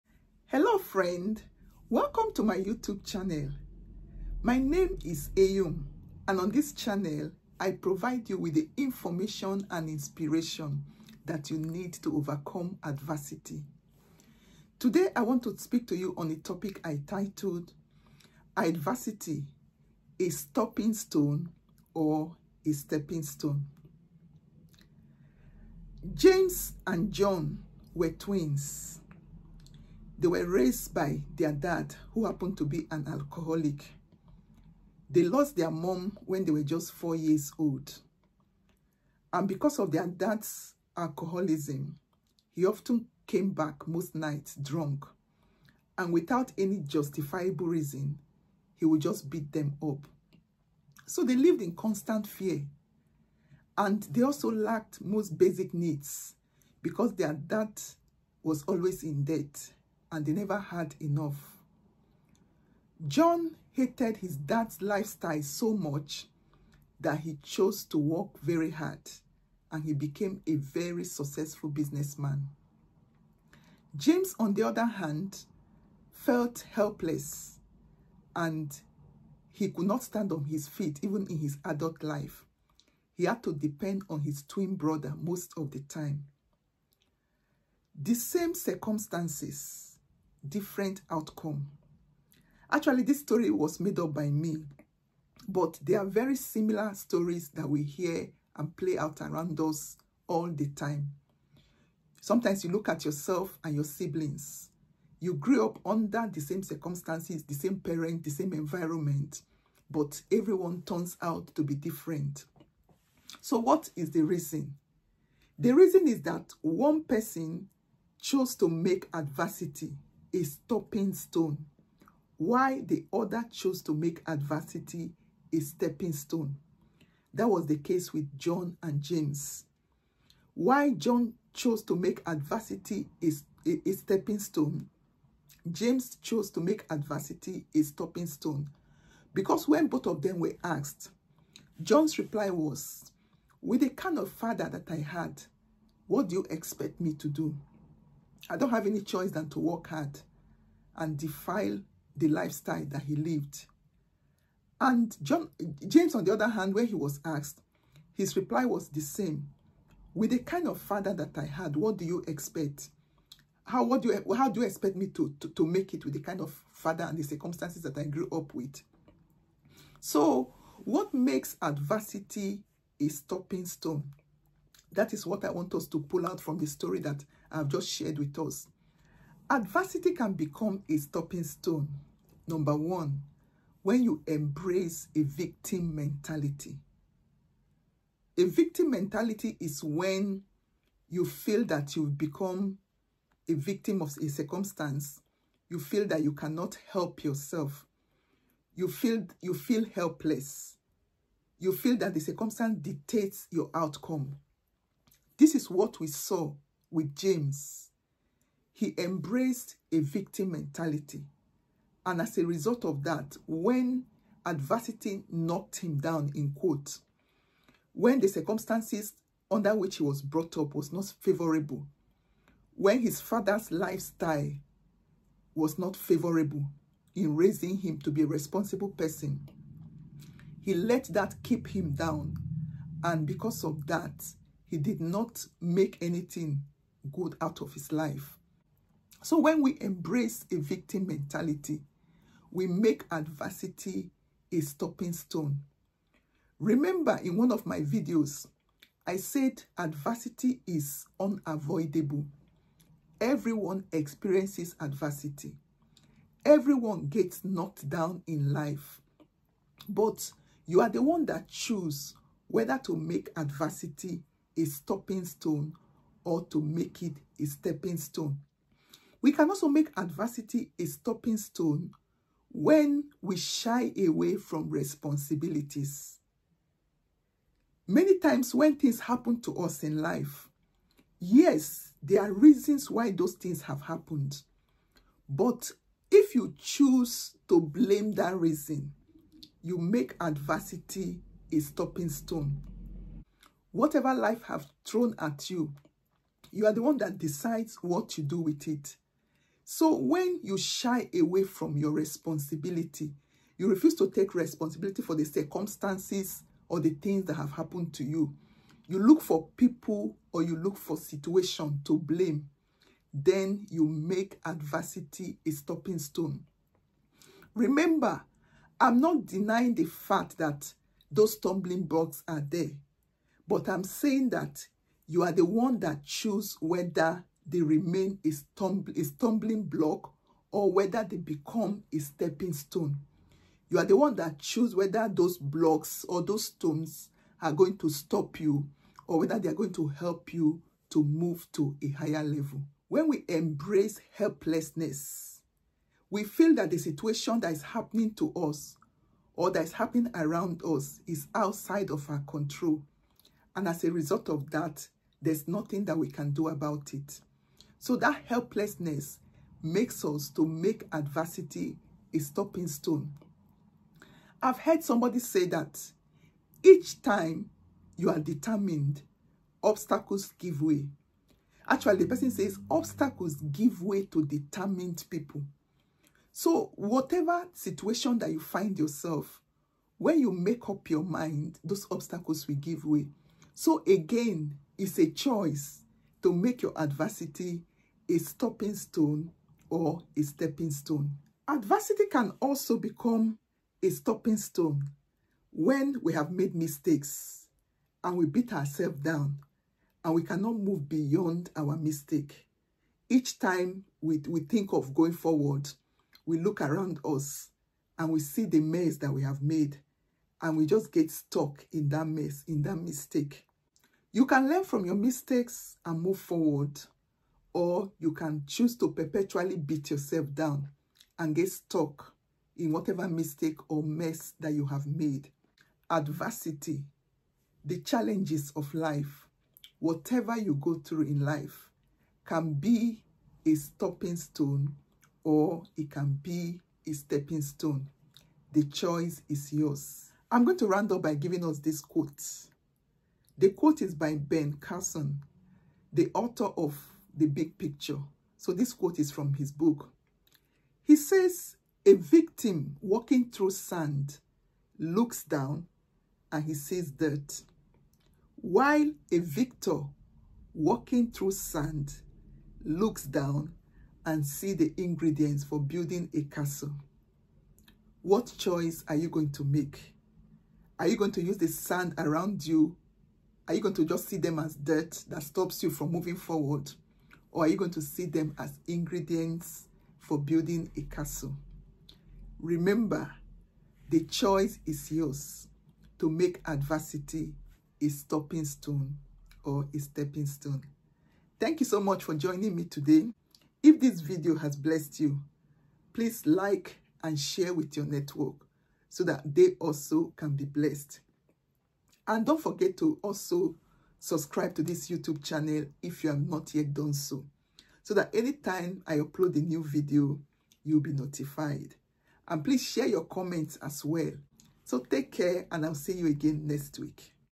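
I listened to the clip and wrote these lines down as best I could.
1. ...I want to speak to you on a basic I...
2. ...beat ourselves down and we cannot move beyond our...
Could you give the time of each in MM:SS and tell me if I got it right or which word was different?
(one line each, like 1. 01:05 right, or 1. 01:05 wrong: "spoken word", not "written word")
1. 00:15 wrong: "topic", not "basic"
2. 06:38 right.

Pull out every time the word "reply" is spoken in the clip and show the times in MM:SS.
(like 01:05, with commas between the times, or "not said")
02:22, 02:38.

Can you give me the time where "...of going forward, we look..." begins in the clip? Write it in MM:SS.
06:44.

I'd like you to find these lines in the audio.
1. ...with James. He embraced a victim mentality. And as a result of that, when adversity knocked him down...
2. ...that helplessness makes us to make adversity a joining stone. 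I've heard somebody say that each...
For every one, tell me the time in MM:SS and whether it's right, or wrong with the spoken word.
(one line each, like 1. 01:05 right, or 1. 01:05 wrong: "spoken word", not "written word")
1. 03:26 right
2. 05:57 wrong: "stopping", not "joining".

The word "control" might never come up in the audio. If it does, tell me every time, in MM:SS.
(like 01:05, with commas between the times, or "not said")
05:52.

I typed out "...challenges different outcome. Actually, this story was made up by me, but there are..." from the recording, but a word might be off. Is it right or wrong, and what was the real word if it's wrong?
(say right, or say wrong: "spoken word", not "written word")
wrong: "circumstances", not "challenges".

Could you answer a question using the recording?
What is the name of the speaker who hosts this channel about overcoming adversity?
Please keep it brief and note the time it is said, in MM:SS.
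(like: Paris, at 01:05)
Eyum, at 00:05.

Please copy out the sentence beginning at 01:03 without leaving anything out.
John hated his dad's lifestyle so much that he chose to work very hard and he became a very successful businessman.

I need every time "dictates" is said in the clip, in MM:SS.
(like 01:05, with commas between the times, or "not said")
03:22.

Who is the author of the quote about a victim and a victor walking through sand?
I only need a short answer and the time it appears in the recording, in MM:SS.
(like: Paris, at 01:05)
Ben Carson, at 07:24.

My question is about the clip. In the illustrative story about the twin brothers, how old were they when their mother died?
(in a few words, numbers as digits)
4.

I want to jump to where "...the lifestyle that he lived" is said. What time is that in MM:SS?
02:32.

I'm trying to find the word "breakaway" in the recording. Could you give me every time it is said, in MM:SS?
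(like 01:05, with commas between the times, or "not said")
not said.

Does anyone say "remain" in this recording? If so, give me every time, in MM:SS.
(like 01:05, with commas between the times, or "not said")
05:27.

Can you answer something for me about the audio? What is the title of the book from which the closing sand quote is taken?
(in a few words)
The Big Picture.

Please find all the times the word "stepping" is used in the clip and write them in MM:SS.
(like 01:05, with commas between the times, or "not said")
00:22, 02:05, 02:13, 04:27, 05:31, 06:30, 07:16, 08:09.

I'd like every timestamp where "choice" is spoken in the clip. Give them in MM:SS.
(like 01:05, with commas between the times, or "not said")
02:29, 06:25, 07:18, 07:48, 08:04.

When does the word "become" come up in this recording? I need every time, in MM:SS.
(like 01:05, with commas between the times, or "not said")
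03:00, 03:12, 05:31, 06:32.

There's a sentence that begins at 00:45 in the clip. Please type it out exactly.
And without any justifiable reason, he would just beat them up.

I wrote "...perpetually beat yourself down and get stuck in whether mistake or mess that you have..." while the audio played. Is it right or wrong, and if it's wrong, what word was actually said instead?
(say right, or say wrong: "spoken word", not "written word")
wrong: "whatever", not "whether".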